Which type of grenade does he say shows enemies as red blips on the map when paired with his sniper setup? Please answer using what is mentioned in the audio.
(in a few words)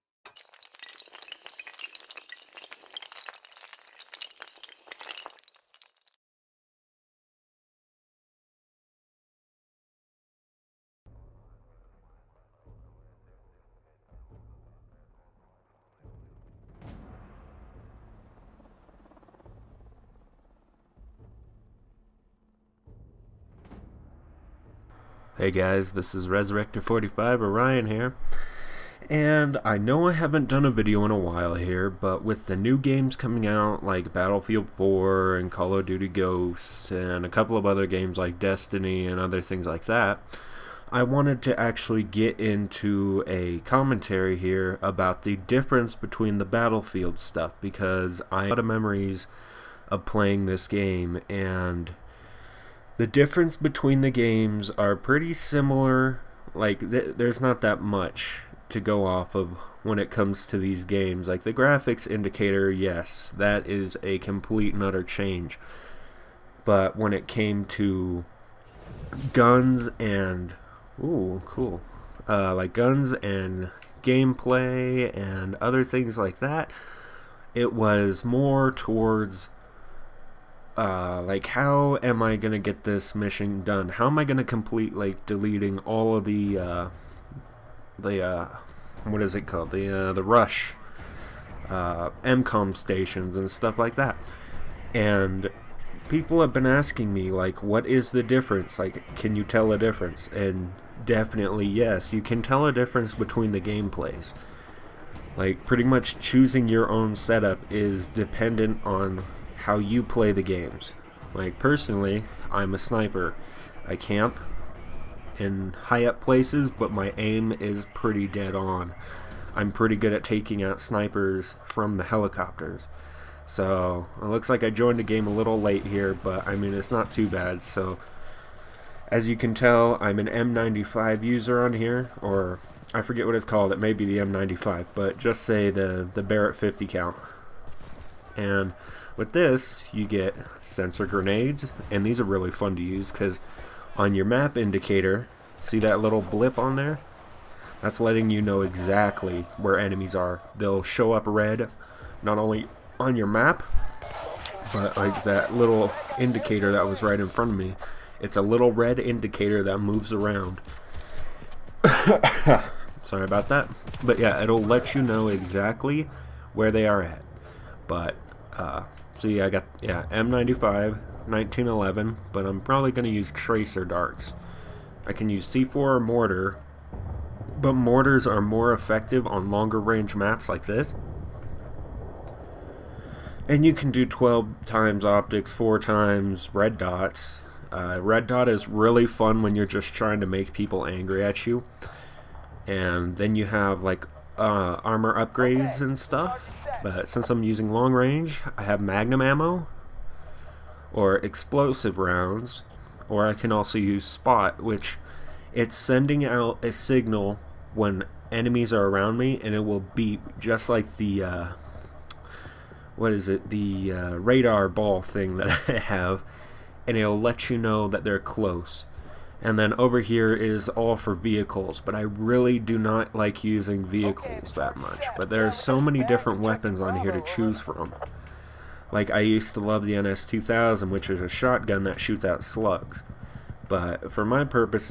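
sensor grenades.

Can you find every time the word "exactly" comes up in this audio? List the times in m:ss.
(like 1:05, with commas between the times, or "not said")
2:28, 2:45.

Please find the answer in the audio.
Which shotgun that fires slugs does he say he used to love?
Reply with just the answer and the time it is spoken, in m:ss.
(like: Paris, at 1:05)
NS-2000, at 3:49.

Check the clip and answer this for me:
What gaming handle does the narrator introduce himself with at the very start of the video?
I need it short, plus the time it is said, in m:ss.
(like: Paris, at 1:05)
Resurrector45 Orion, at 0:26.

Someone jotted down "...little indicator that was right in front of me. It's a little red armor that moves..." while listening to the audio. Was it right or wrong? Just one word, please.
wrong.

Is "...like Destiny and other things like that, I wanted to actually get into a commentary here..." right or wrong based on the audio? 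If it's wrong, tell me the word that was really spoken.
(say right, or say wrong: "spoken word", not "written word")
right.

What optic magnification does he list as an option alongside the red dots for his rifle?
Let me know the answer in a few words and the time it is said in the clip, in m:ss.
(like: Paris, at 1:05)
12 times, at 3:04.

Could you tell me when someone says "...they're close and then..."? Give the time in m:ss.
3:38.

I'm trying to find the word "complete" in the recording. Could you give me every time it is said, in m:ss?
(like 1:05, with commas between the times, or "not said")
1:04, 1:24.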